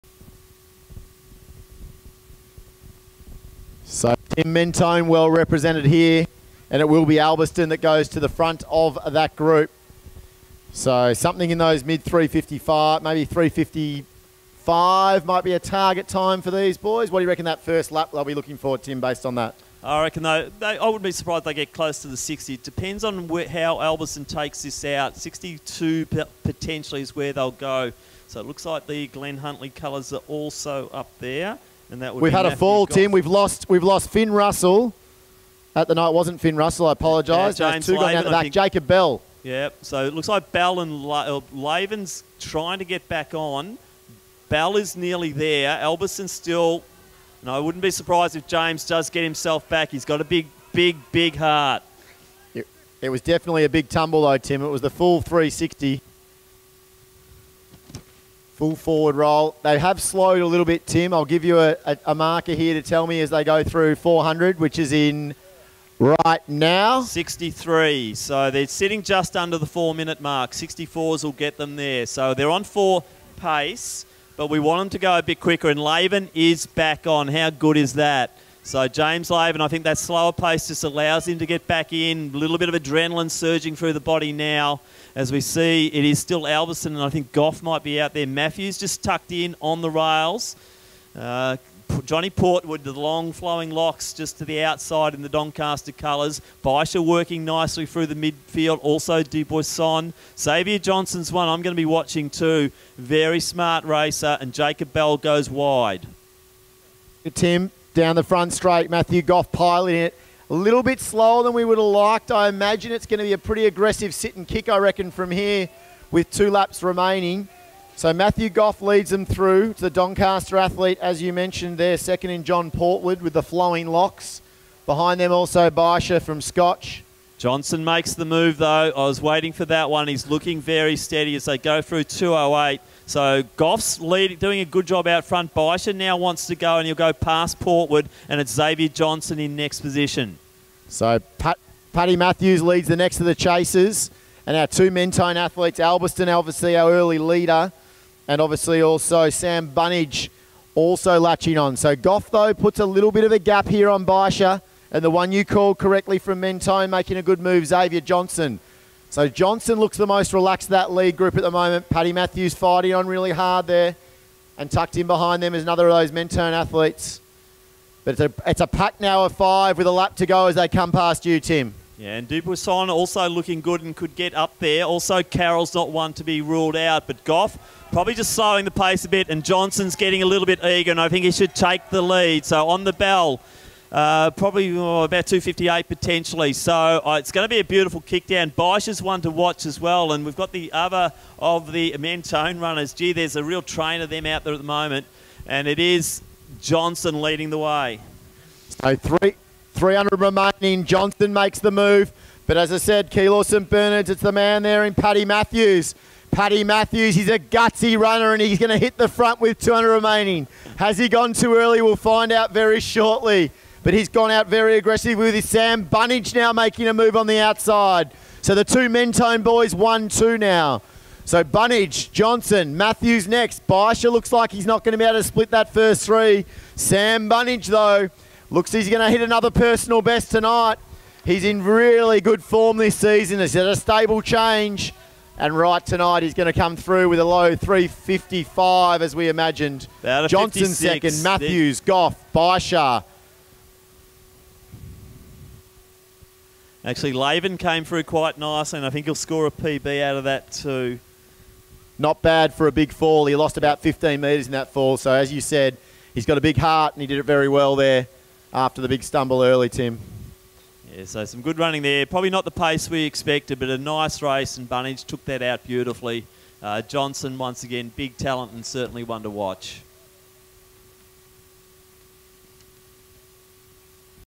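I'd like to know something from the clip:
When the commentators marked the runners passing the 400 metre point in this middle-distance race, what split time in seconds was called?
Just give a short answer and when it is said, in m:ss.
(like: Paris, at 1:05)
63, at 1:07.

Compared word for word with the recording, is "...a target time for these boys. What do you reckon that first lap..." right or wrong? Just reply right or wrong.
right.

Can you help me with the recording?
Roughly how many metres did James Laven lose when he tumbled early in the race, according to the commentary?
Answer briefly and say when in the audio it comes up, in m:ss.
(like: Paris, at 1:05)
15 metres, at 4:13.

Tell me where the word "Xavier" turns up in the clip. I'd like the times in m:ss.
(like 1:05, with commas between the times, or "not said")
1:40, 2:18, 2:37.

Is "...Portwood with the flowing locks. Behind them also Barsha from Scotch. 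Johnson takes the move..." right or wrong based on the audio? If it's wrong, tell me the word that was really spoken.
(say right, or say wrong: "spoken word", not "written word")
wrong: "makes", not "takes".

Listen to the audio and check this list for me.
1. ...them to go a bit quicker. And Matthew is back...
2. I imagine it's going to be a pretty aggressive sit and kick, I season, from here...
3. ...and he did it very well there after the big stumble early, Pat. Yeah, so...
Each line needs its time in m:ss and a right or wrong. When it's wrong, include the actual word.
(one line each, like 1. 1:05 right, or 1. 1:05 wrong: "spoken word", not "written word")
1. 1:14 wrong: "Laven", not "Matthew"
2. 1:52 wrong: "reckon", not "season"
3. 4:16 wrong: "Tim", not "Pat".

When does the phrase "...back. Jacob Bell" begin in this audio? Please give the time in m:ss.
0:38.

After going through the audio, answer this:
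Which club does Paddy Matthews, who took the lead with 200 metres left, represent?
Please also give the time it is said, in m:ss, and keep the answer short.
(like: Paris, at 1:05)
Keilor St. Bernard's, at 3:23.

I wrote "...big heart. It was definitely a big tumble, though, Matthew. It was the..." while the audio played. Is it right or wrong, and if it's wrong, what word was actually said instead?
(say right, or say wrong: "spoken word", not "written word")
wrong: "Tim", not "Matthew".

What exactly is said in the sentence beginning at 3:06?
So uh, it's going to be a beautiful kick down.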